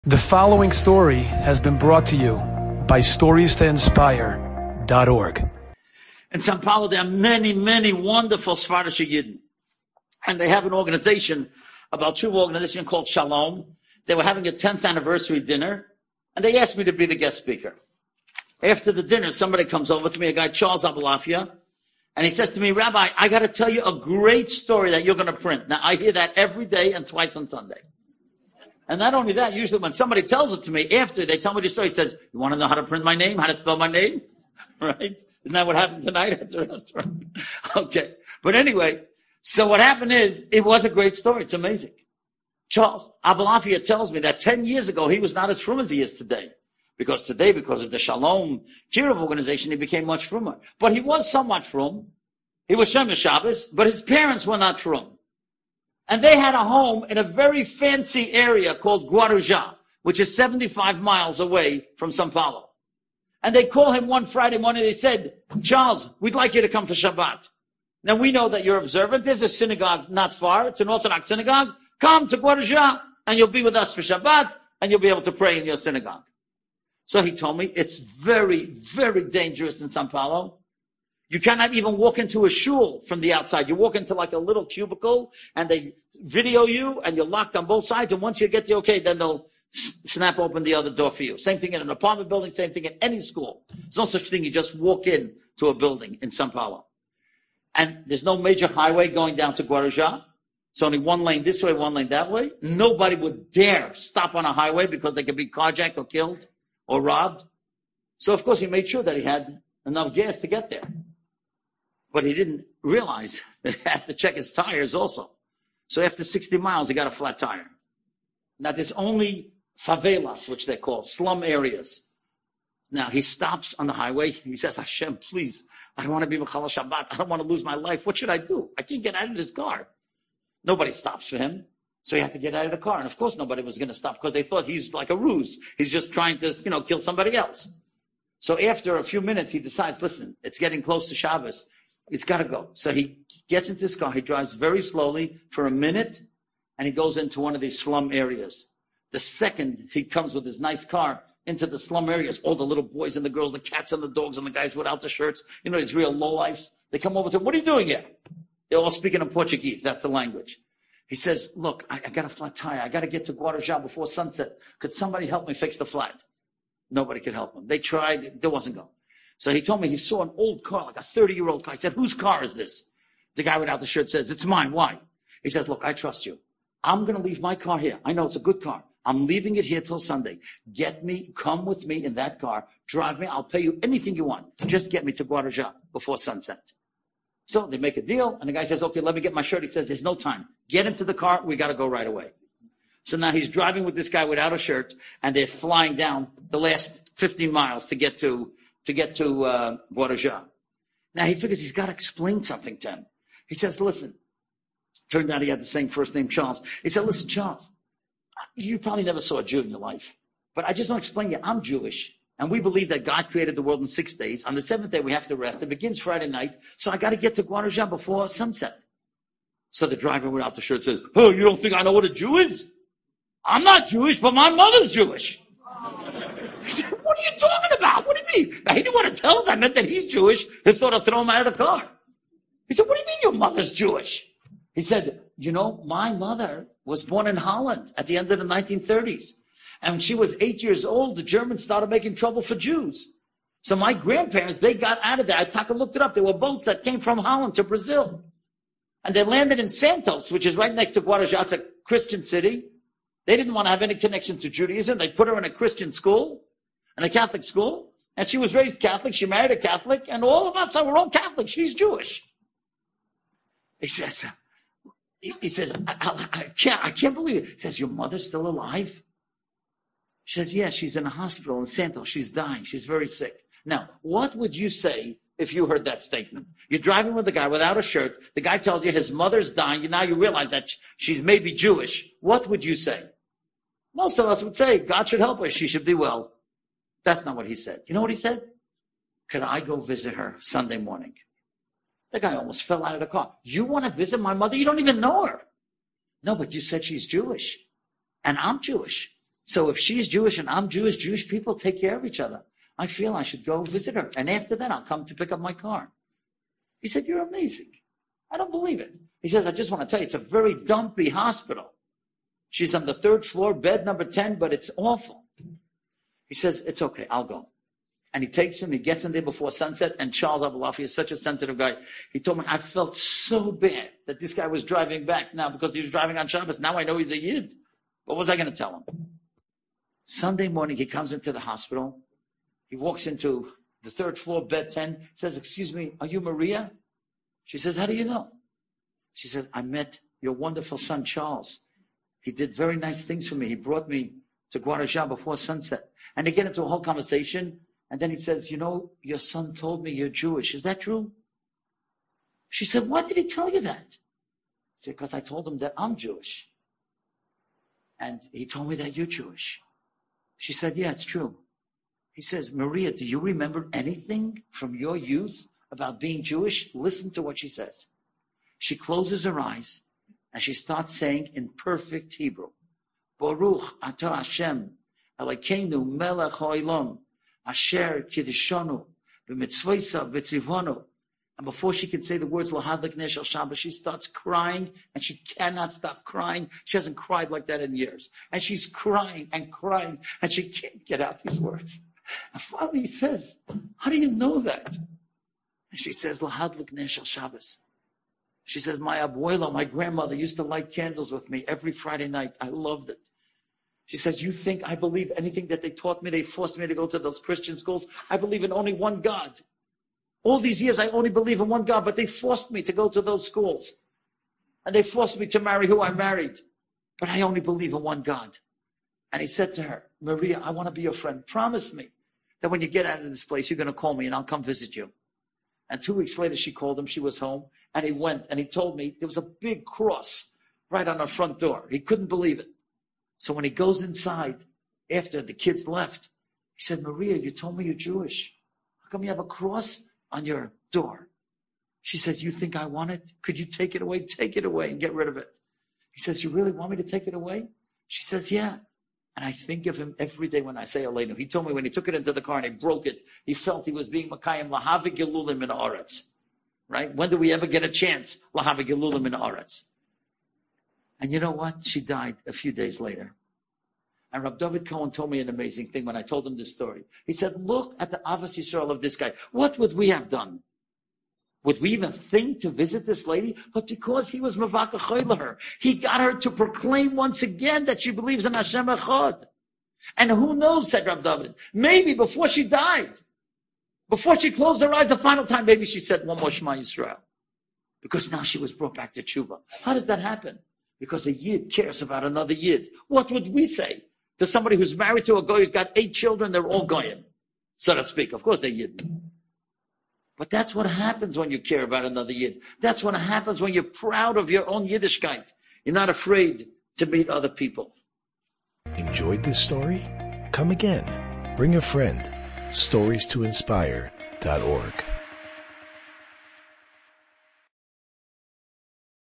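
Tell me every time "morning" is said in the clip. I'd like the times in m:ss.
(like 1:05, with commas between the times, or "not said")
1:04, 4:50, 5:30.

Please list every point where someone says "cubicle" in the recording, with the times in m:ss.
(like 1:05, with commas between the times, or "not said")
1:24.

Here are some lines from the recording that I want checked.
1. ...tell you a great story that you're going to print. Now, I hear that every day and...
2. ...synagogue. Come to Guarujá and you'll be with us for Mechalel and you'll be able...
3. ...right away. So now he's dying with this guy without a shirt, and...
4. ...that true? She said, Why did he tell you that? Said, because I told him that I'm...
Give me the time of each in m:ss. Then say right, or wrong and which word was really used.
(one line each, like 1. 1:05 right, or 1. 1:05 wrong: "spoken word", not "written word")
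1. 0:23 right
2. 1:11 wrong: "Shabbat", not "Mechalel"
3. 3:11 wrong: "driving", not "dying"
4. 5:50 right.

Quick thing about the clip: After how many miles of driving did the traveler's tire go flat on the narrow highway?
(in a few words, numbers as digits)
60 miles.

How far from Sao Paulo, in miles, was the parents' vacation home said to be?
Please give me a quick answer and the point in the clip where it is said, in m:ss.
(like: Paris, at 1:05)
75 miles, at 1:00.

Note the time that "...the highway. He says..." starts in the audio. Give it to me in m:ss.
2:03.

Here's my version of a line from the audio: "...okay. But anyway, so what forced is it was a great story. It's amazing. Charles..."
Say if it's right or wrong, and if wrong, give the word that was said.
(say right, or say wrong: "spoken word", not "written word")
wrong: "happened", not "forced".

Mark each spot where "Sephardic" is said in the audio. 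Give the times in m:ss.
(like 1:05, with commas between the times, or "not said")
0:08.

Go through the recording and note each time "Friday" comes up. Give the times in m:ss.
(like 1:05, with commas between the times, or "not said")
1:04, 3:35, 6:41.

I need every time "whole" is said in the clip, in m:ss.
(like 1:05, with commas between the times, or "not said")
5:46.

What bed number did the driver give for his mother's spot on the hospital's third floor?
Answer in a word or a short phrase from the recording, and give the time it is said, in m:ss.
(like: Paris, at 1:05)
10, at 5:13.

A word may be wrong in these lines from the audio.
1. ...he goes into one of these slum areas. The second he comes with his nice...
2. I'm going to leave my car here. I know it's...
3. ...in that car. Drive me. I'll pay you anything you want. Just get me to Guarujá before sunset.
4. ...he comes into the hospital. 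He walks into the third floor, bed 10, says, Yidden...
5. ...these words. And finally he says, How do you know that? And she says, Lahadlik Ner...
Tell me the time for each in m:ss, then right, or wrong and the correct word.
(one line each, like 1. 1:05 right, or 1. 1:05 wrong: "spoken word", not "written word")
1. 2:26 right
2. 2:56 right
3. 3:02 right
4. 5:30 wrong: "Excuse", not "Yidden"
5. 6:31 right.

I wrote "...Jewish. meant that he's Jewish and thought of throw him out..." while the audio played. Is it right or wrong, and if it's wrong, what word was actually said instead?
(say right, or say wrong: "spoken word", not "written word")
right.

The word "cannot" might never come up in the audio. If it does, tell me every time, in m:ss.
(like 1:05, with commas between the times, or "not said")
1:21, 6:25.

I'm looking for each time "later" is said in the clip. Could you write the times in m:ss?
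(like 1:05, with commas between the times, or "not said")
7:06, 7:42.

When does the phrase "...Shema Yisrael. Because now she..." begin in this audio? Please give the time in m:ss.
8:06.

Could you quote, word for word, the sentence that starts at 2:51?
He said, whose car is this?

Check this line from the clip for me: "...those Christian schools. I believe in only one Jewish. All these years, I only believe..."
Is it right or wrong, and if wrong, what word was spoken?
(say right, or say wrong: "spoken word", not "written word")
wrong: "God", not "Jewish".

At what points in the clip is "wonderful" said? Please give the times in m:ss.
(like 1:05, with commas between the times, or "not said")
0:07, 5:40.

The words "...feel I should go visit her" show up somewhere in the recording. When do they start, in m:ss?
5:02.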